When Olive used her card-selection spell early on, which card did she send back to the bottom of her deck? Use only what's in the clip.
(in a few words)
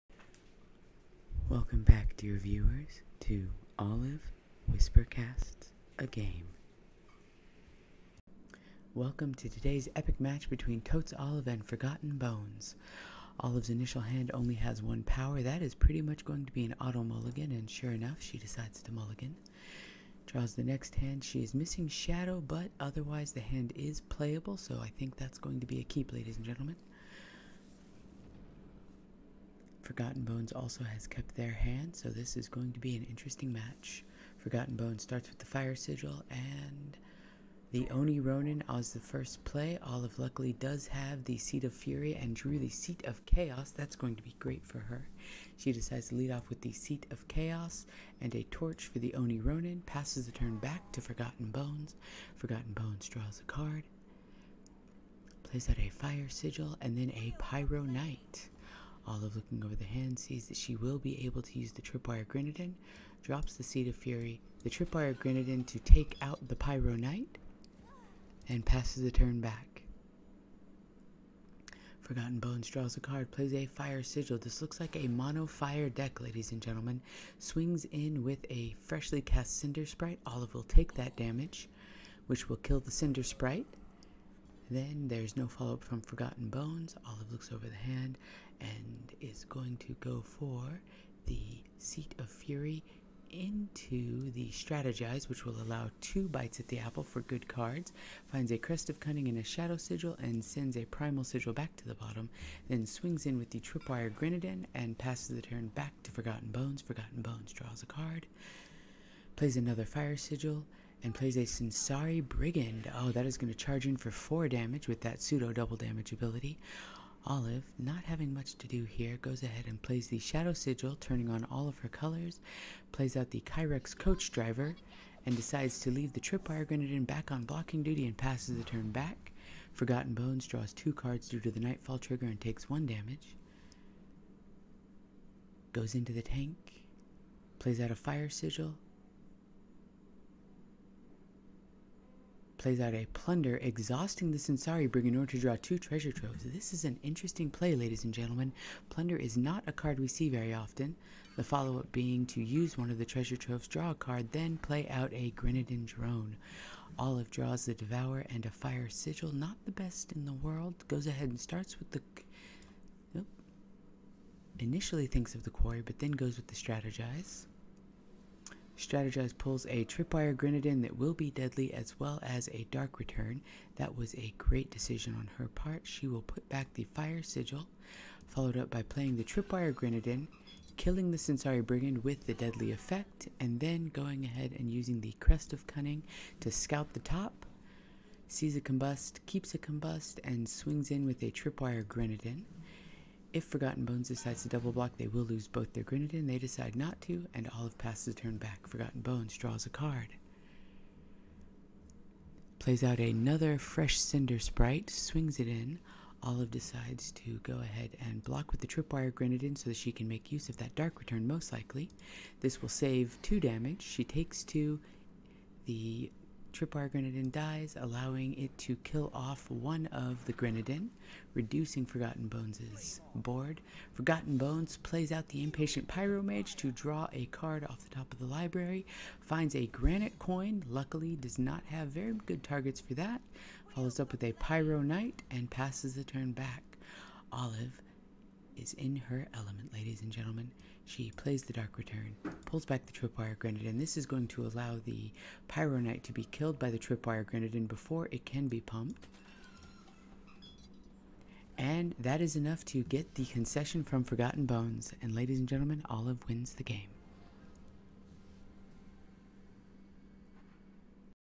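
Primal Sigil.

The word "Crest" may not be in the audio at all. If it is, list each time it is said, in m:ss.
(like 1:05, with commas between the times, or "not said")
1:38, 3:05.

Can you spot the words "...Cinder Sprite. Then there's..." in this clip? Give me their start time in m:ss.
1:22.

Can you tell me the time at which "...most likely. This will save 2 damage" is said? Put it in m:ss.
3:31.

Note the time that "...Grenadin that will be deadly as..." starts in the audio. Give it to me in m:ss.
2:50.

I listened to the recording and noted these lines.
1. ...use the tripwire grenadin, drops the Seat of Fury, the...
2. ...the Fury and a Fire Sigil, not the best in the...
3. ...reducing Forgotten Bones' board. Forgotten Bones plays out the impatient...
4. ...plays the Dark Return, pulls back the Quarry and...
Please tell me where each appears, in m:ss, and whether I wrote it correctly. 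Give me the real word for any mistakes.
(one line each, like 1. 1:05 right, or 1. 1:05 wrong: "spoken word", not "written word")
1. 1:01 right
2. 2:37 wrong: "Devourer", not "Fury"
3. 3:41 right
4. 4:01 wrong: "Tripwire", not "Quarry".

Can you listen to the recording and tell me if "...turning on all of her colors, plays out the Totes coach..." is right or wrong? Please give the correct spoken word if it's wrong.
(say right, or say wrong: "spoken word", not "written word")
wrong: "Kyrex", not "Totes".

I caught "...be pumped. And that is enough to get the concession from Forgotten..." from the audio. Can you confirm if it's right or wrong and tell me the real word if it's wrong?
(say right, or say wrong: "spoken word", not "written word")
right.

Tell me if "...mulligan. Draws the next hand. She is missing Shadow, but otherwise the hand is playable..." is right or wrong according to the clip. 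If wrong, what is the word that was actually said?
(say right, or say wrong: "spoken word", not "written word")
right.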